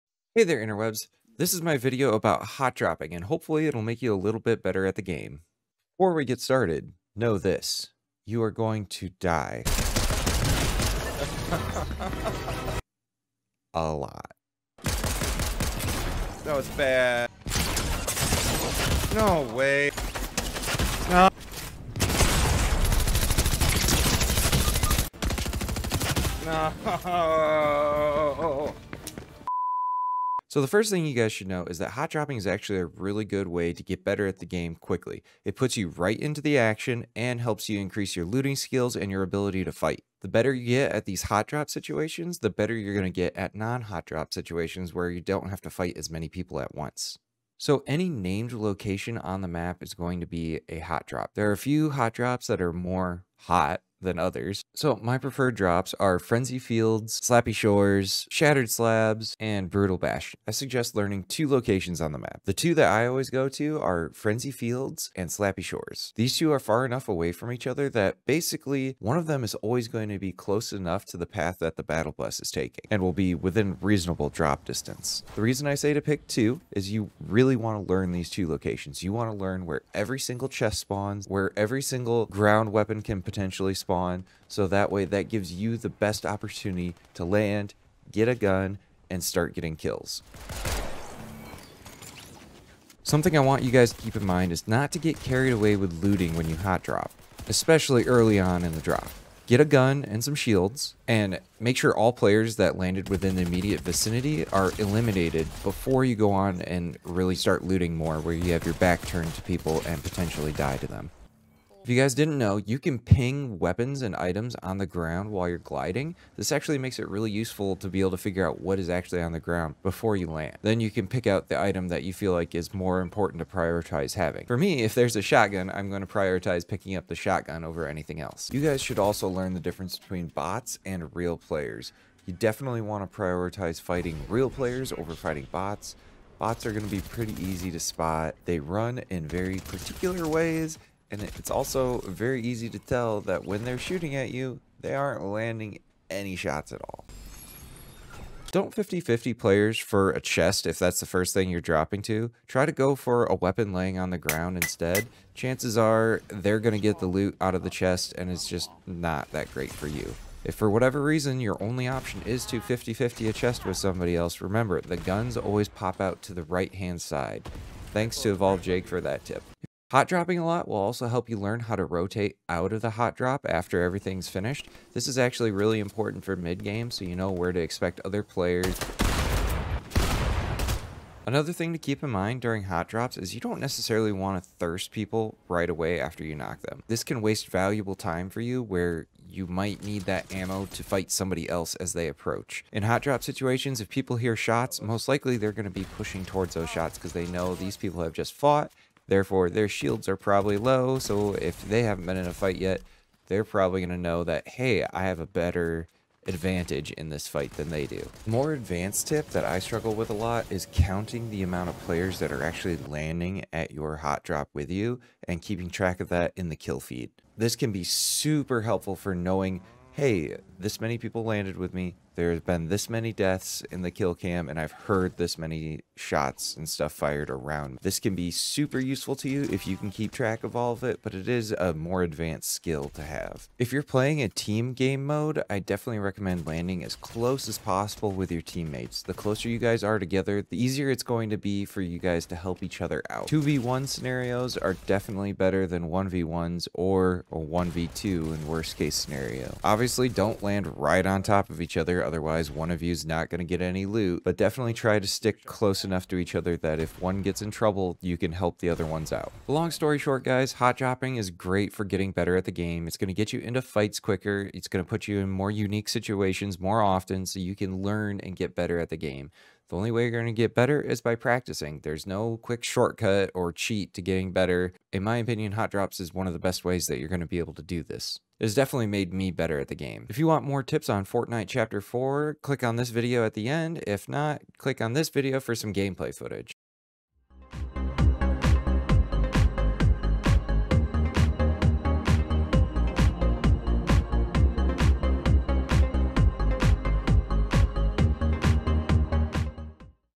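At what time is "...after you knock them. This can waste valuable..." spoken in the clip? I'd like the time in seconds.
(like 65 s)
185 s.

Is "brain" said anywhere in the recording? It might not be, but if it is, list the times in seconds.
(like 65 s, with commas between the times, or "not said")
not said.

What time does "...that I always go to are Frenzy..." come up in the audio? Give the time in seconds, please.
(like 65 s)
62 s.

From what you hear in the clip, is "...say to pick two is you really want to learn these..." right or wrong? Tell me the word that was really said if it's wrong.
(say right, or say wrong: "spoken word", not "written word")
right.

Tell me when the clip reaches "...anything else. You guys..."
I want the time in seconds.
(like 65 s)
127 s.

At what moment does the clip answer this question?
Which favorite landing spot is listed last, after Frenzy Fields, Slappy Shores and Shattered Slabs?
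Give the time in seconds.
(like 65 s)
59 s.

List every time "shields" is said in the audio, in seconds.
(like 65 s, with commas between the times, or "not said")
100 s, 199 s.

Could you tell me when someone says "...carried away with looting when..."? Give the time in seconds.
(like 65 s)
95 s.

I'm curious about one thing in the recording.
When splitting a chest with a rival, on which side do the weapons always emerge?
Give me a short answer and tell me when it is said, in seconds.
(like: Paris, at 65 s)
right hand side, at 166 s.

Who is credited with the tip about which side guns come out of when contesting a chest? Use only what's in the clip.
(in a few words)
Evolve Jake.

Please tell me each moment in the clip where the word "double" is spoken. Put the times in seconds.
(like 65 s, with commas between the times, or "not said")
not said.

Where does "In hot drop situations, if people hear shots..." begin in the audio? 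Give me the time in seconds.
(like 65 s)
192 s.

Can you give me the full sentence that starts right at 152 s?
Try to go for a weapon laying on the ground instead.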